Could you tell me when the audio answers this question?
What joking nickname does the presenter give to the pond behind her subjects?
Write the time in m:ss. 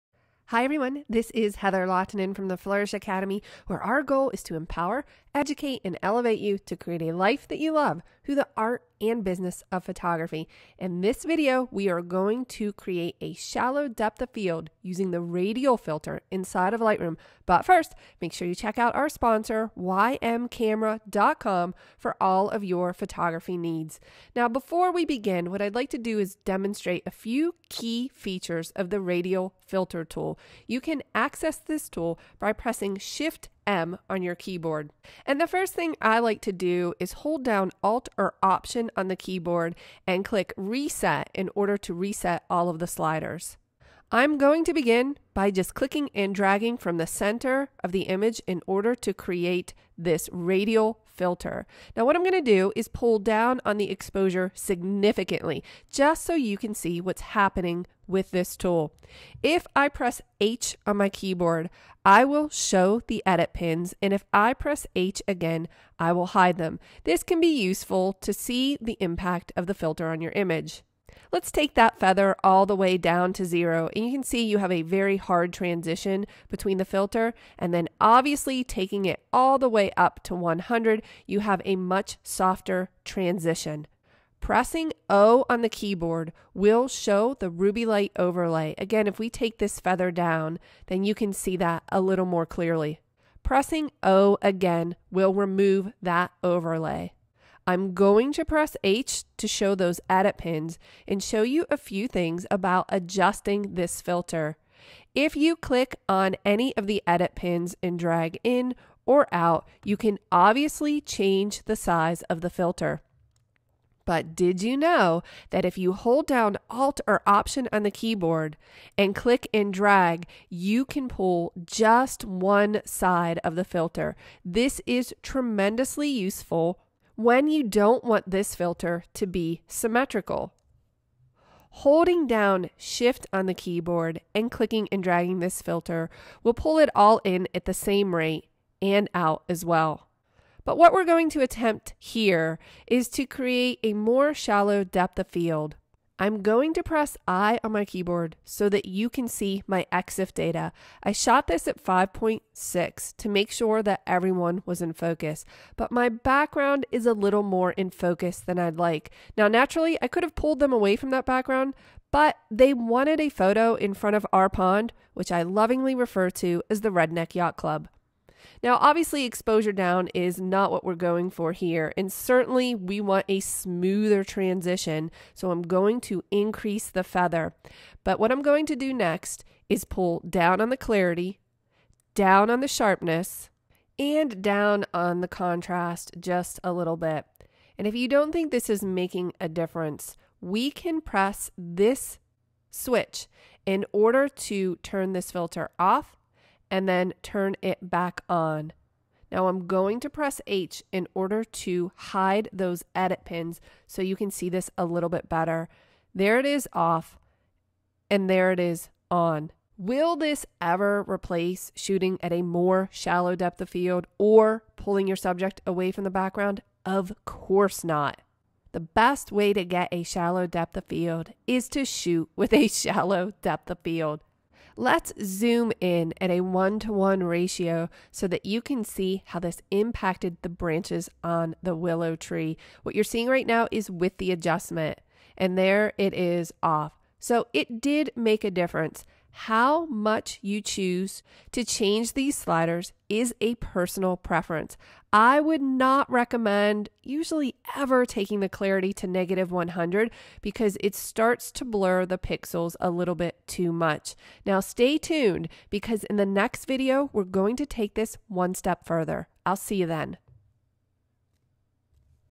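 2:46.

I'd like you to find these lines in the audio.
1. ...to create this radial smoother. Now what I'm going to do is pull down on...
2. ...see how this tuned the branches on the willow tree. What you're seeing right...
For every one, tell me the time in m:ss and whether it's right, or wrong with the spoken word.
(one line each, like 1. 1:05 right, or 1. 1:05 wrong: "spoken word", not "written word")
1. 0:48 wrong: "filter", not "smoother"
2. 3:48 wrong: "impacted", not "tuned".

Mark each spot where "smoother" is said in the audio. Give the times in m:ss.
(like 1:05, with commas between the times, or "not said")
2:53.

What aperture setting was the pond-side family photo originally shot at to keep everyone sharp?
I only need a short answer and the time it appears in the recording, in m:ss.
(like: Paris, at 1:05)
5.6, at 2:31.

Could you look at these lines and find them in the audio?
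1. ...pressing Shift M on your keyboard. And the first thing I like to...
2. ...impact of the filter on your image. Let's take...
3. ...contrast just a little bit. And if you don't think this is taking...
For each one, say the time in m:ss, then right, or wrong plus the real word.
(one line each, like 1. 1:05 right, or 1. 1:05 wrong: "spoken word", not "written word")
1. 0:32 right
2. 1:08 right
3. 3:05 wrong: "making", not "taking".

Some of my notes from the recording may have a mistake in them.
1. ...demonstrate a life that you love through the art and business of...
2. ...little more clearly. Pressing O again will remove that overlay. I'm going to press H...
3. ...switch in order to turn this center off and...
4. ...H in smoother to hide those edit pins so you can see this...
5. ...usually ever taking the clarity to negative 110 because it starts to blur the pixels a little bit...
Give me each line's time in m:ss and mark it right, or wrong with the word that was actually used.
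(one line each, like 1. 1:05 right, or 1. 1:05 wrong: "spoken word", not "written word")
1. 0:06 wrong: "create", not "demonstrate"
2. 1:32 right
3. 3:12 wrong: "filter", not "center"
4. 3:20 wrong: "order", not "smoother"
5. 4:07 wrong: "100", not "110".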